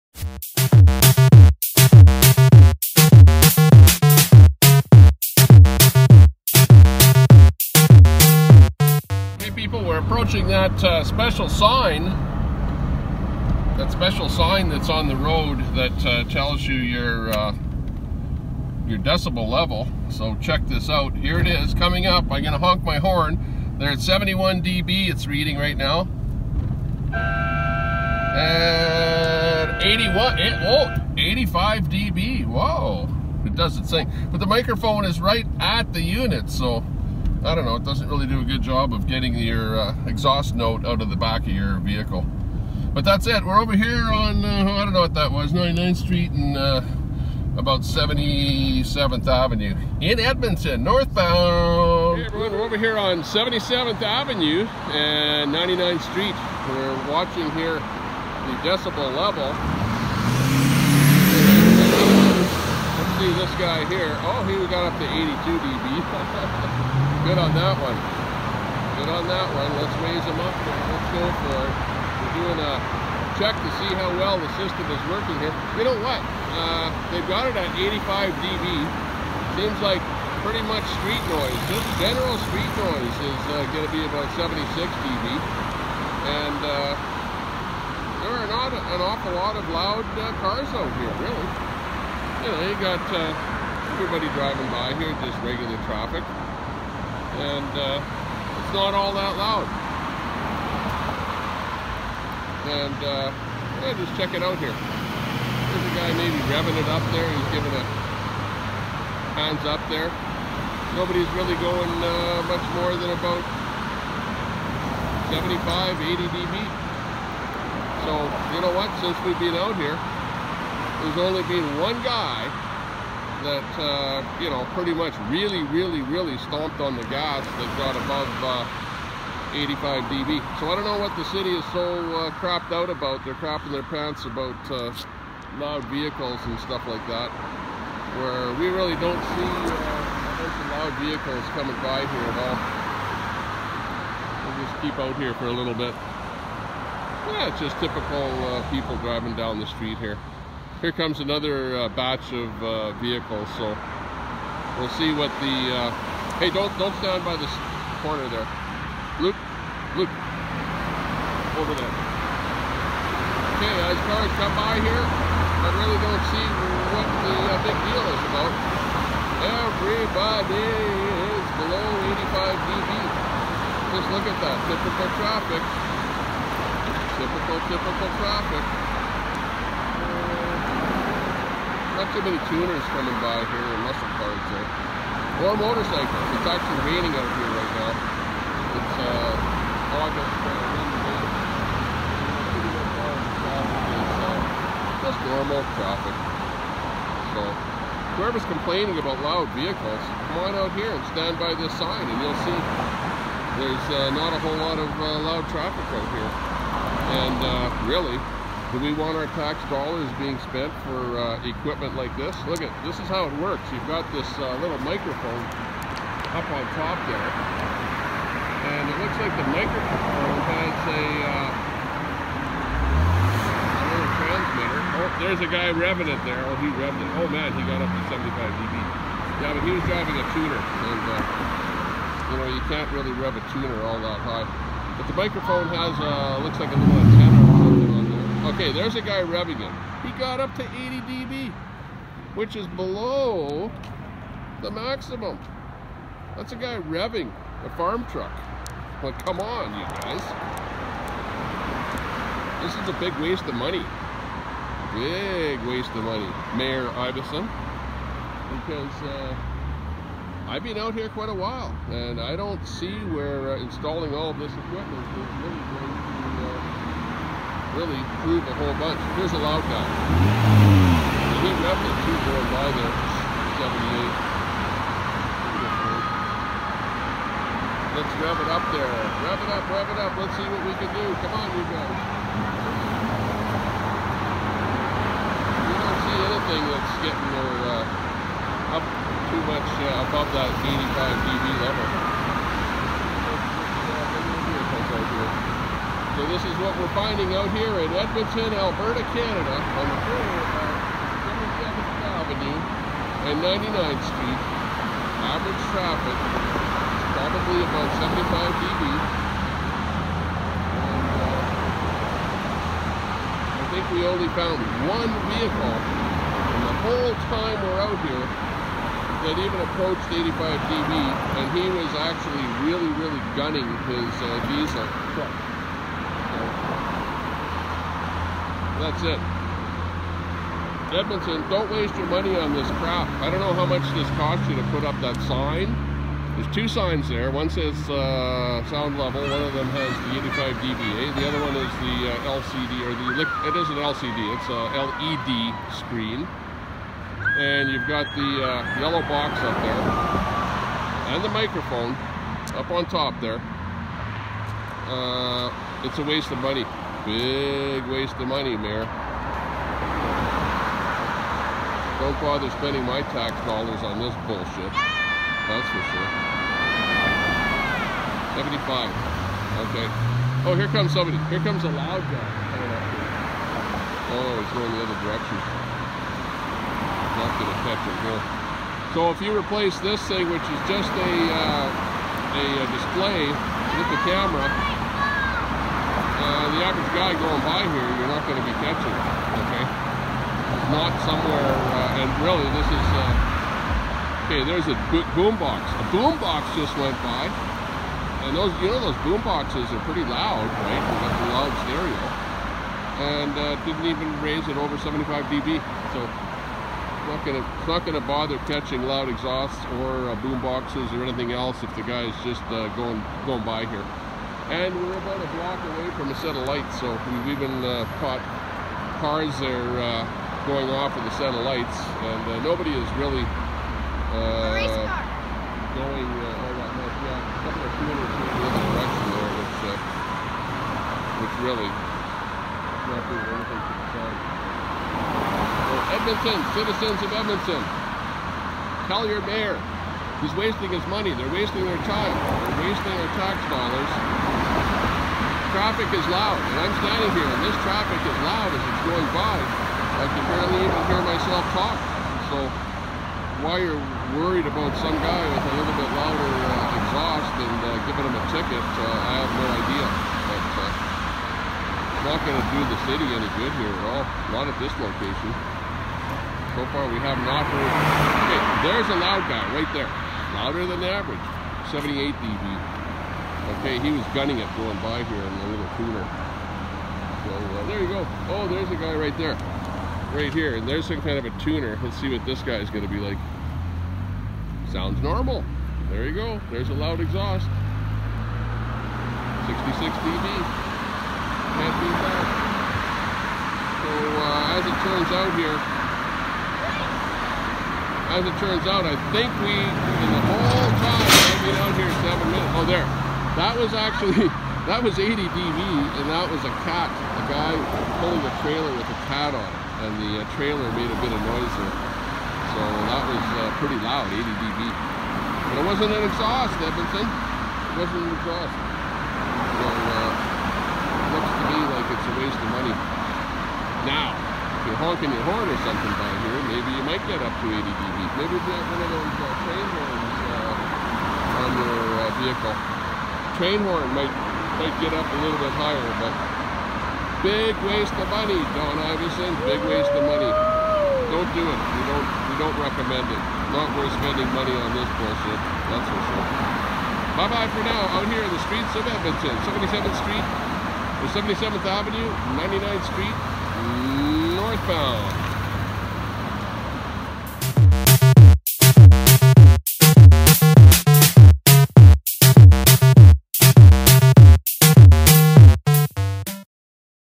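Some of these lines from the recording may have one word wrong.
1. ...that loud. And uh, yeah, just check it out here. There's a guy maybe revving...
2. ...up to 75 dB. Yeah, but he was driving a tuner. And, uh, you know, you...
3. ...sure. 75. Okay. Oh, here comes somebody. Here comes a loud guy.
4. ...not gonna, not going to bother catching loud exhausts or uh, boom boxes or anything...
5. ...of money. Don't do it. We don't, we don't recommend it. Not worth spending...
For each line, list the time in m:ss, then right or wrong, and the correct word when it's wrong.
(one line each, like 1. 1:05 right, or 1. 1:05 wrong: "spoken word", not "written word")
1. 1:39 right
2. 3:47 right
3. 6:05 right
4. 6:47 right
5. 8:59 right.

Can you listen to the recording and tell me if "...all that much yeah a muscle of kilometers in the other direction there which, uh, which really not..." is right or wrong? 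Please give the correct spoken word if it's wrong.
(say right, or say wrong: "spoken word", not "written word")
wrong: "couple", not "muscle".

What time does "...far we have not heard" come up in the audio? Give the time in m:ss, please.
7:46.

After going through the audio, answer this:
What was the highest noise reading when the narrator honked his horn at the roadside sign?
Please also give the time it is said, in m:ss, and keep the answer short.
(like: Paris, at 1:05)
85 dB, at 0:31.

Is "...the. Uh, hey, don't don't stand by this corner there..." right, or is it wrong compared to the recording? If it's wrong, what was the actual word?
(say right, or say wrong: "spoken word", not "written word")
right.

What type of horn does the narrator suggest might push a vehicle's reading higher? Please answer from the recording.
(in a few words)
train horn.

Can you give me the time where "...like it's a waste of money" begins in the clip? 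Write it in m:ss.
8:41.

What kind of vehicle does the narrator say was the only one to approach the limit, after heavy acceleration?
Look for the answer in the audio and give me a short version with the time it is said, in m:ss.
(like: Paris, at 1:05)
diesel truck, at 5:24.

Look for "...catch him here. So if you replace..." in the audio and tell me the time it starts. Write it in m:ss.
6:17.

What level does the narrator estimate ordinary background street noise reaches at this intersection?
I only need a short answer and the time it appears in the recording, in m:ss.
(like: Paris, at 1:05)
76 dB, at 1:24.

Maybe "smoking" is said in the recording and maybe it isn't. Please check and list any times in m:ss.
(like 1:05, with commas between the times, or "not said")
not said.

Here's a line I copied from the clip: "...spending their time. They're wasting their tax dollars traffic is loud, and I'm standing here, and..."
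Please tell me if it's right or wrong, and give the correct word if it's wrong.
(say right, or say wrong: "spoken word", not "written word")
wrong: "wasting", not "spending".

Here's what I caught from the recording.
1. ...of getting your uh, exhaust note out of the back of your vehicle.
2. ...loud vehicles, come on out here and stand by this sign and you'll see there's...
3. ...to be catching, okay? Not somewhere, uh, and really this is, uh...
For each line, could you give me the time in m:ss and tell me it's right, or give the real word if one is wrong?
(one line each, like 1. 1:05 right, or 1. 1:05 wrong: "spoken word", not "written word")
1. 0:38 right
2. 3:19 right
3. 6:28 right.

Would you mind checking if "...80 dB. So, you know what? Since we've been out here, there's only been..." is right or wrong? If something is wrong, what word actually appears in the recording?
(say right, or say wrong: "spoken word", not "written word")
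right.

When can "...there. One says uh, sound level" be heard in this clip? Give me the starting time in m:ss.
5:37.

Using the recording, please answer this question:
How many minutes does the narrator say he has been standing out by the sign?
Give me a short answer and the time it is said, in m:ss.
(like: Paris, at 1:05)
seven, at 8:22.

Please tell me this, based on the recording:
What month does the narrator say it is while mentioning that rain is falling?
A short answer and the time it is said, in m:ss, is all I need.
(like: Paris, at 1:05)
August, at 3:10.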